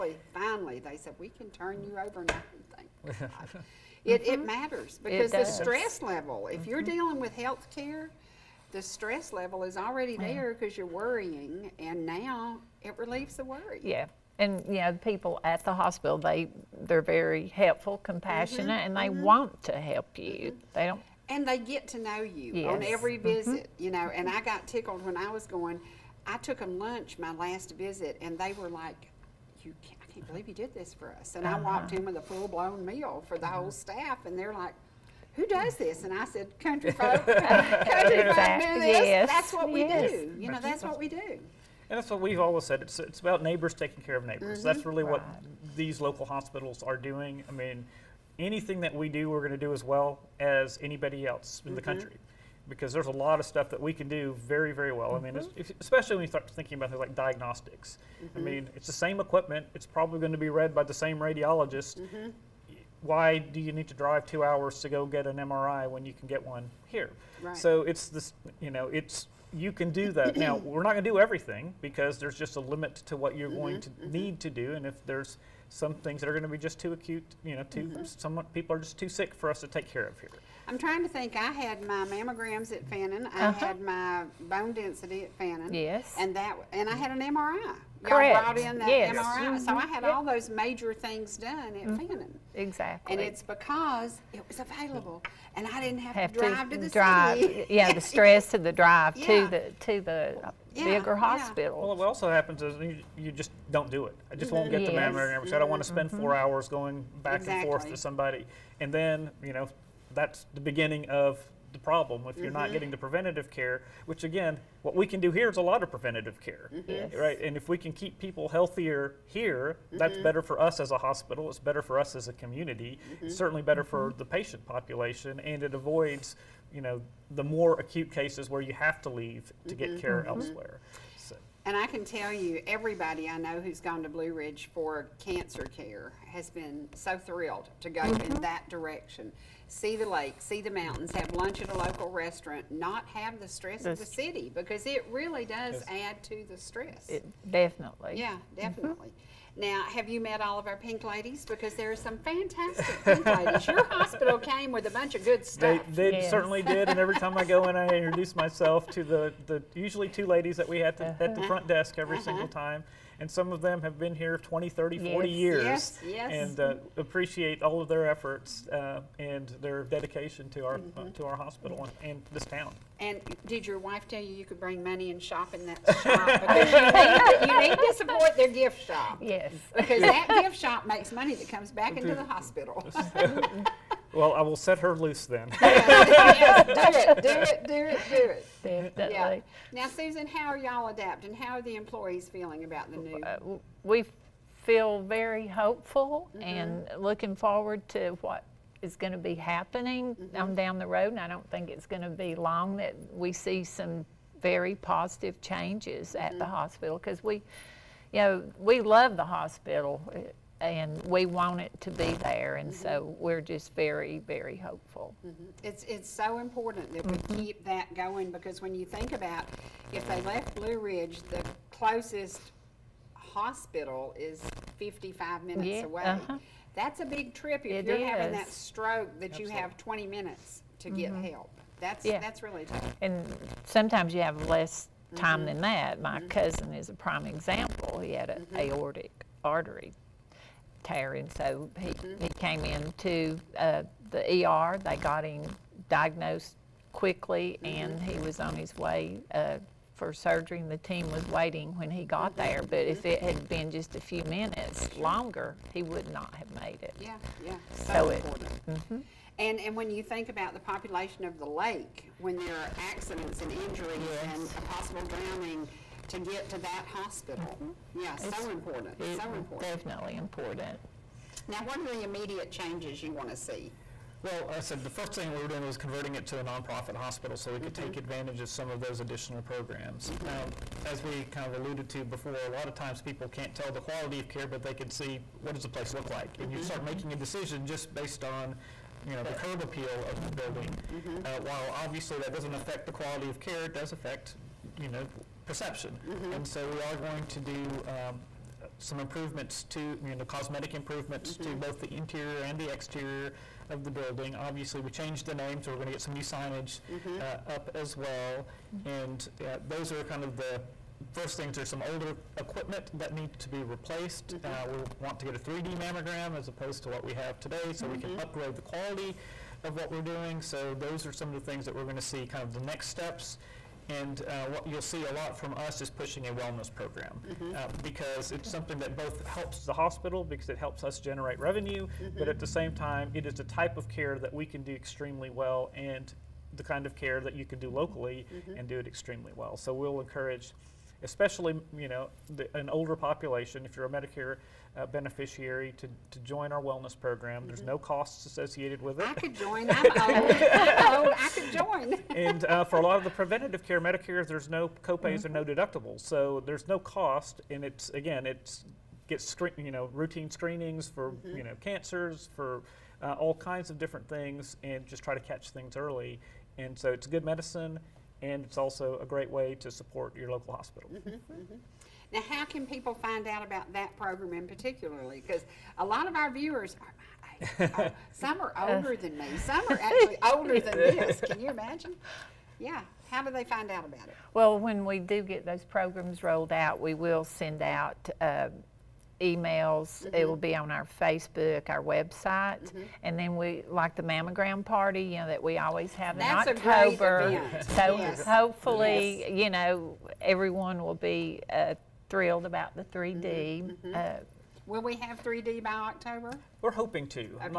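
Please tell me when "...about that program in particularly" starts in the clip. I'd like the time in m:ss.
6:13.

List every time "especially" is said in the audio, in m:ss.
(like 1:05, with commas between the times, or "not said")
0:55, 5:41.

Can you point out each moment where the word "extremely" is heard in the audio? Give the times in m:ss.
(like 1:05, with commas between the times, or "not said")
5:34, 5:38.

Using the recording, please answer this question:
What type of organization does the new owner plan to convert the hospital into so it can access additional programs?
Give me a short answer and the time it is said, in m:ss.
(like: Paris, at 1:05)
Nonprofit hospital, at 4:36.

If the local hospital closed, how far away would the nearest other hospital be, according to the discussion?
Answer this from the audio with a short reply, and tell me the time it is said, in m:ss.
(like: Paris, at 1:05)
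55 minutes, at 3:44.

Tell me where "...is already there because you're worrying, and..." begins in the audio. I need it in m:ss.
0:09.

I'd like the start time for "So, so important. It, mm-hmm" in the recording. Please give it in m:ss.
4:17.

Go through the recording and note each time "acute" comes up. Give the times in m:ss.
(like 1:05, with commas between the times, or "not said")
1:16, 2:07.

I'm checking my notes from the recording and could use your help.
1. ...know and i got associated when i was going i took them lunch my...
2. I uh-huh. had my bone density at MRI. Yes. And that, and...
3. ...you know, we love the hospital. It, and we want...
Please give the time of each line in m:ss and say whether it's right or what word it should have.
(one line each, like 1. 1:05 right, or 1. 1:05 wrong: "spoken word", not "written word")
1. 0:23 wrong: "tickled", not "associated"
2. 1:23 wrong: "Fannin", not "MRI"
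3. 3:28 right.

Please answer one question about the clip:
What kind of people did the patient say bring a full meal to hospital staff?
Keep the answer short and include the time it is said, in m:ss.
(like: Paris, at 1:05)
Country folk, at 0:36.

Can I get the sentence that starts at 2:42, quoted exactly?
single time and some of them have been here 20, 30, 40 yes, years.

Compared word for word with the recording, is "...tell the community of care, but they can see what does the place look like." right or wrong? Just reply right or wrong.
wrong.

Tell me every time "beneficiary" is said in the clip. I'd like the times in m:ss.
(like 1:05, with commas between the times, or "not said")
5:44.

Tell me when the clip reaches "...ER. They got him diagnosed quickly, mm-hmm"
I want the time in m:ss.
4:04.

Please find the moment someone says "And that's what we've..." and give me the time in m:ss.
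0:41.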